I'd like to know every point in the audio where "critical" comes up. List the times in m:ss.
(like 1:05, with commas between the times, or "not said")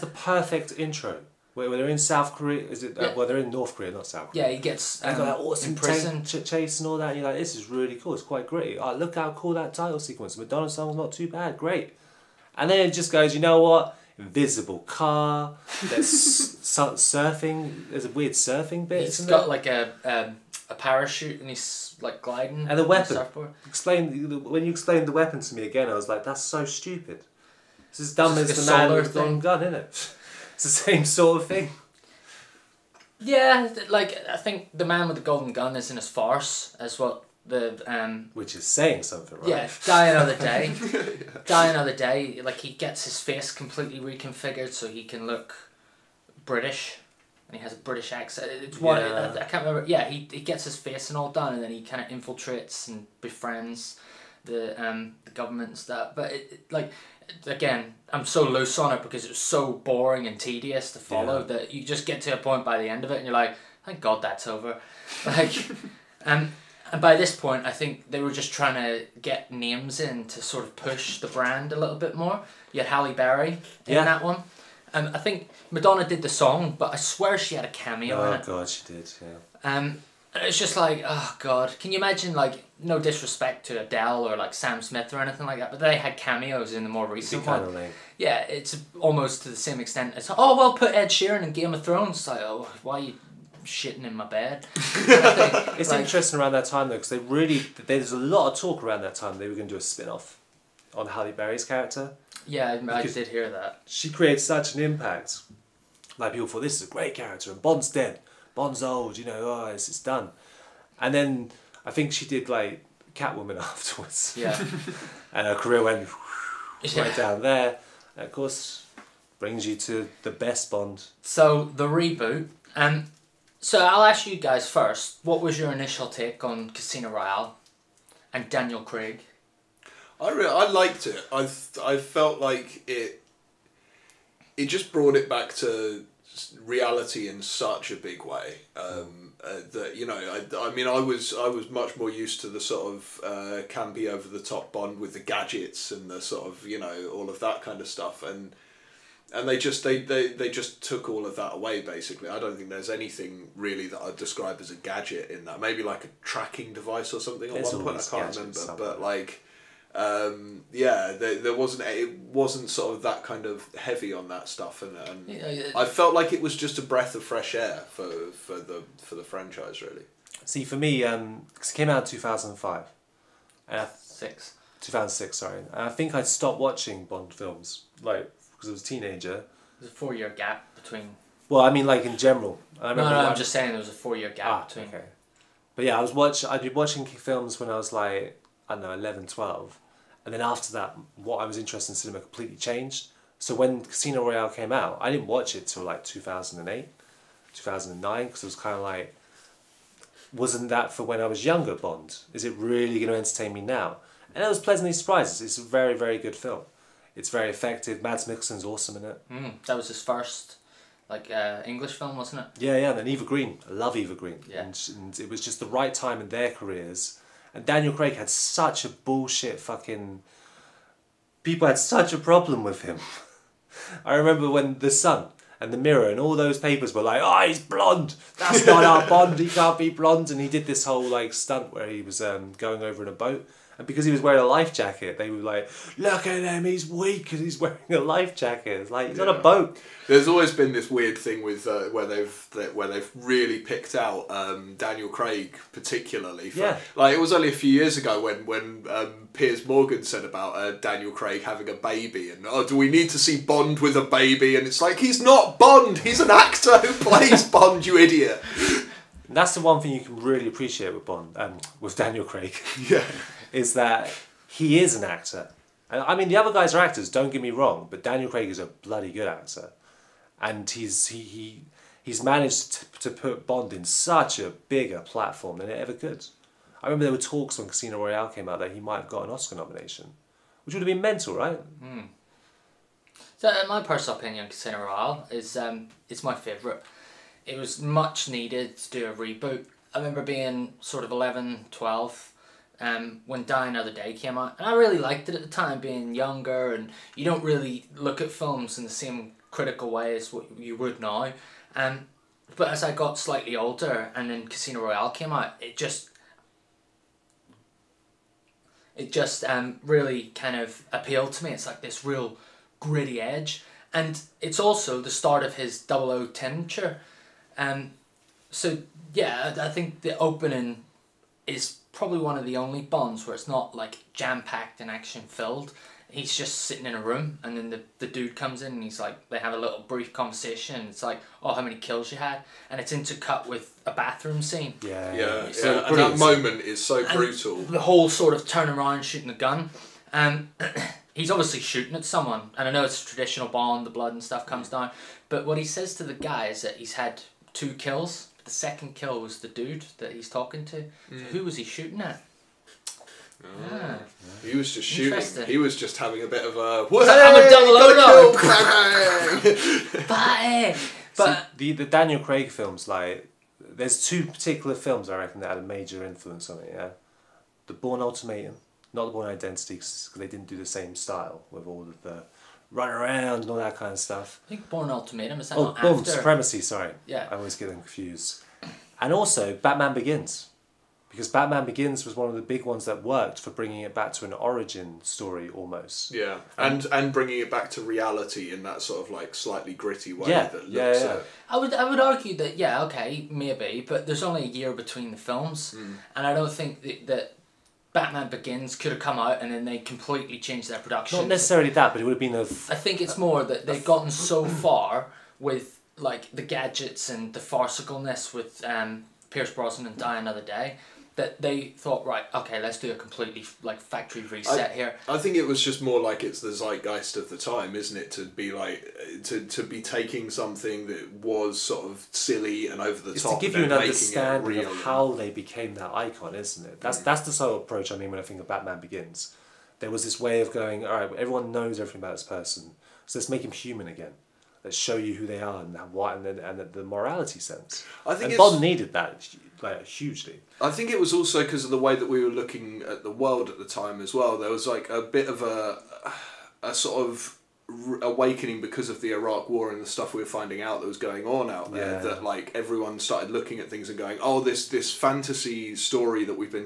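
4:59.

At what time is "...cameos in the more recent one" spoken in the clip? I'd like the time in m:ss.
1:26.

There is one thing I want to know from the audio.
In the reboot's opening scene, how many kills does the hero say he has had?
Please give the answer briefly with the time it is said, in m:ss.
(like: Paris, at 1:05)
2, at 5:47.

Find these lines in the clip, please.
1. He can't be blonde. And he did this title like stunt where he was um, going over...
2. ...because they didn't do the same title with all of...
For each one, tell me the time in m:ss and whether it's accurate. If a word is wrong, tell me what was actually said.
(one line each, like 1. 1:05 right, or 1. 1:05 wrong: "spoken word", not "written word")
1. 3:49 wrong: "whole", not "title"
2. 6:09 wrong: "style", not "title".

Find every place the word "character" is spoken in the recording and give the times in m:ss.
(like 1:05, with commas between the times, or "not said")
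1:41, 1:47.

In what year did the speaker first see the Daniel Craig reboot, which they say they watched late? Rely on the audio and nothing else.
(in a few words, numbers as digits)
2008.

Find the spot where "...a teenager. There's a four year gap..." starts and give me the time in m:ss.
2:58.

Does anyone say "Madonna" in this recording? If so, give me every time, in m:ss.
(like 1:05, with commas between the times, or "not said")
0:10, 1:15.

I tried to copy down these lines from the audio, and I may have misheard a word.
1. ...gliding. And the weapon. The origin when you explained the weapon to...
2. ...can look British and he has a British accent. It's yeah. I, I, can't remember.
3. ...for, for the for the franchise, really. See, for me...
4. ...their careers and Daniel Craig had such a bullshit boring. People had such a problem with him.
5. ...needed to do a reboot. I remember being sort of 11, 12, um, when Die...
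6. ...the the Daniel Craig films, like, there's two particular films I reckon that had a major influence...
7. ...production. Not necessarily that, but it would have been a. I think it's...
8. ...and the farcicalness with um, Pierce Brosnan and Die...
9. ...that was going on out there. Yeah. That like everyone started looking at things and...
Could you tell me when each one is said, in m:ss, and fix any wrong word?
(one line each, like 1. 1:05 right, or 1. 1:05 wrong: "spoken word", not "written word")
1. 0:22 wrong: "explain", not "origin"
2. 0:45 right
3. 2:47 right
4. 3:36 wrong: "fucking", not "boring"
5. 4:48 right
6. 6:01 right
7. 6:40 right
8. 6:47 right
9. 7:30 right.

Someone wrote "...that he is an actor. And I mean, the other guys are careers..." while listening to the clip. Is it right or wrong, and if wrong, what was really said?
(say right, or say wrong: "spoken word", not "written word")
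wrong: "actors", not "careers".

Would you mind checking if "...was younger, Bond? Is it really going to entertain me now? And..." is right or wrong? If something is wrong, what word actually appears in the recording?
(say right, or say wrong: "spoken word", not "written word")
right.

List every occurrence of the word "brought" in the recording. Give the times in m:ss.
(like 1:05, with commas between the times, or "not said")
2:14.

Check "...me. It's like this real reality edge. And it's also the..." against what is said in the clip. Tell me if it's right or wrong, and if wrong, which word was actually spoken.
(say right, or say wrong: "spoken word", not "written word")
wrong: "gritty", not "reality".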